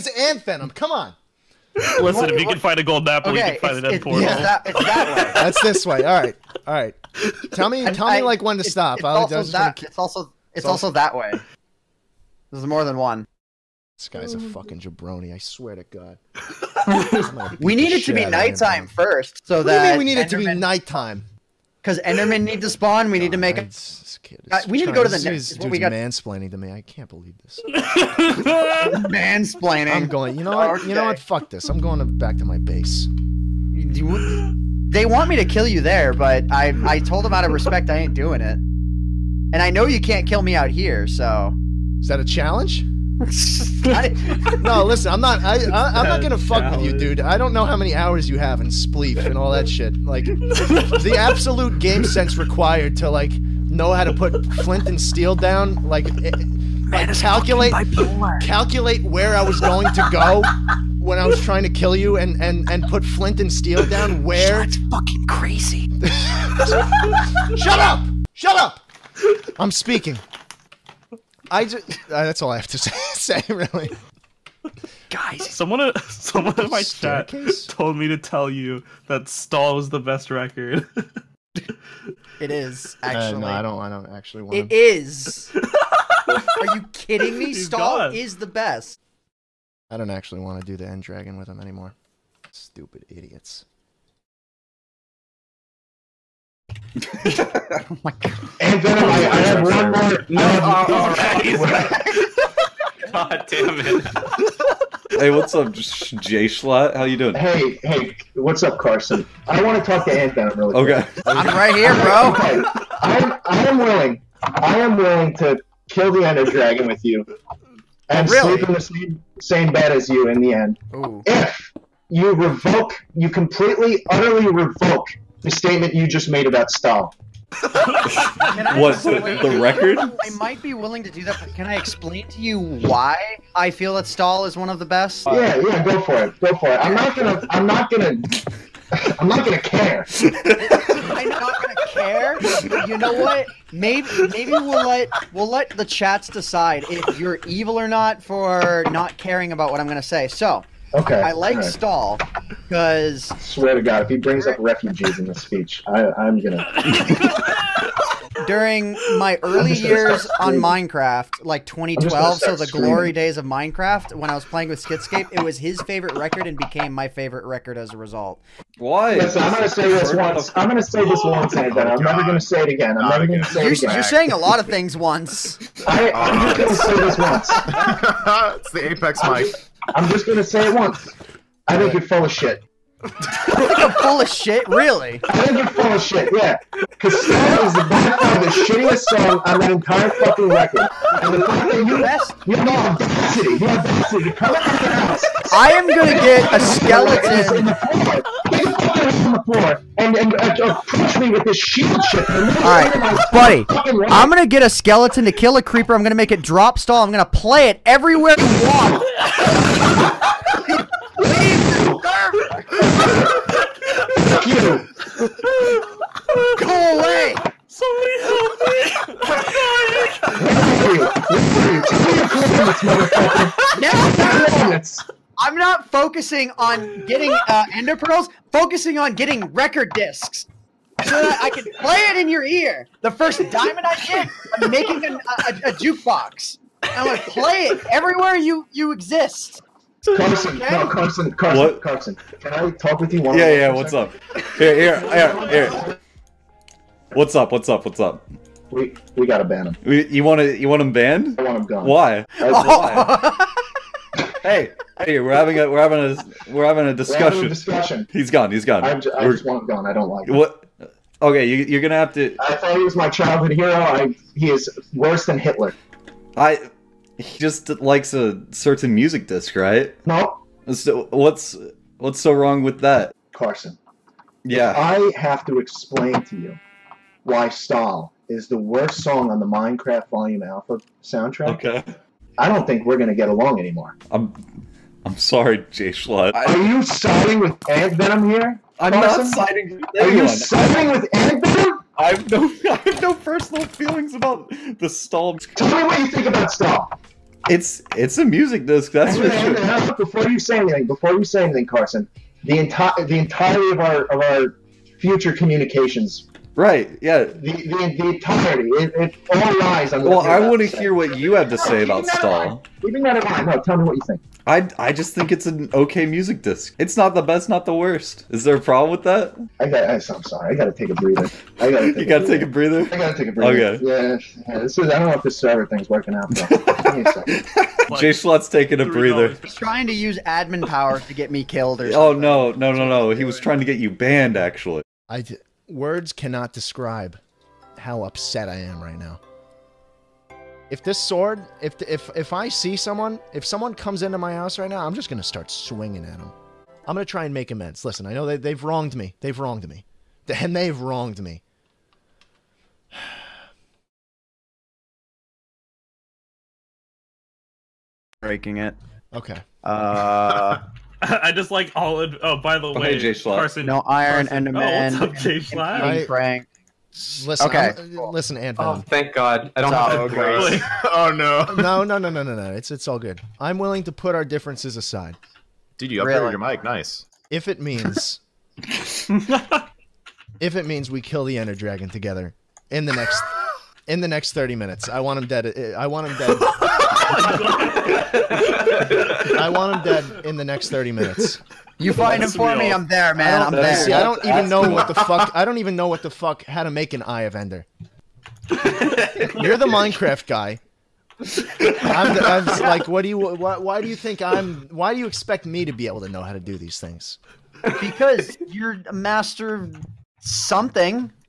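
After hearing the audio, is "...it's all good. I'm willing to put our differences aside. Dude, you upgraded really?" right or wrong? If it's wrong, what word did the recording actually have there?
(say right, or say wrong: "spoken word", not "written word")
right.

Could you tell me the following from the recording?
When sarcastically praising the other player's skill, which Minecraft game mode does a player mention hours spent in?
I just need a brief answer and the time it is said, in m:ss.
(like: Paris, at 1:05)
spleef, at 0:48.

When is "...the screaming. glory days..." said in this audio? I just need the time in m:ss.
2:42.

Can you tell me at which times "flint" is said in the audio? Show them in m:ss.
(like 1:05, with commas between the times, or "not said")
0:54, 1:03.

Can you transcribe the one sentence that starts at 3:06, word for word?
because is the by far the shittiest song on that entire fucking record.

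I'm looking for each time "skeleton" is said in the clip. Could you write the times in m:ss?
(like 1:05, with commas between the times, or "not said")
3:16, 3:24.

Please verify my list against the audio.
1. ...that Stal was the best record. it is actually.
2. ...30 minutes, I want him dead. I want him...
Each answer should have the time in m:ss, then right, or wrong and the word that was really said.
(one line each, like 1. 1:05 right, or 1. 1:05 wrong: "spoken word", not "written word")
1. 1:19 right
2. 6:24 right.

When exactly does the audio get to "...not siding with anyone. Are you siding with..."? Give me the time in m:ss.
4:48.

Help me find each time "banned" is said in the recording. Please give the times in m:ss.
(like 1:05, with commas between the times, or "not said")
4:10, 5:33.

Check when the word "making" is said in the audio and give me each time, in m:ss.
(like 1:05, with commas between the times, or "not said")
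3:54.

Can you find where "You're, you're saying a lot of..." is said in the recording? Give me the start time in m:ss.
2:53.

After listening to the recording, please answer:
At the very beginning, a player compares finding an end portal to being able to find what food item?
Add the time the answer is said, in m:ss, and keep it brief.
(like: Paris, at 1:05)
gold apple, at 0:02.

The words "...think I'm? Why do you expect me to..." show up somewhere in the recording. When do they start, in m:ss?
6:43.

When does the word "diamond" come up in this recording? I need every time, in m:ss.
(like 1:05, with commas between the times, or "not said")
3:53.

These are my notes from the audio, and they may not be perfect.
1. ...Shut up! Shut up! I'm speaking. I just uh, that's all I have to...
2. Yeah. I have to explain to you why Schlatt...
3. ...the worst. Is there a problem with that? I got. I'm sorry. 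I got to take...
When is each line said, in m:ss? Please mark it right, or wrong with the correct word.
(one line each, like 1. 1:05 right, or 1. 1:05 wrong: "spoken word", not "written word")
1. 1:07 right
2. 4:34 wrong: "Stal", not "Schlatt"
3. 5:17 right.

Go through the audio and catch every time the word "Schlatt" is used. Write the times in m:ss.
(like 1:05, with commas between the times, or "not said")
1:46, 4:45, 5:28, 6:05.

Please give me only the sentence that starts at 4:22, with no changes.
I thought he was my childhood hero.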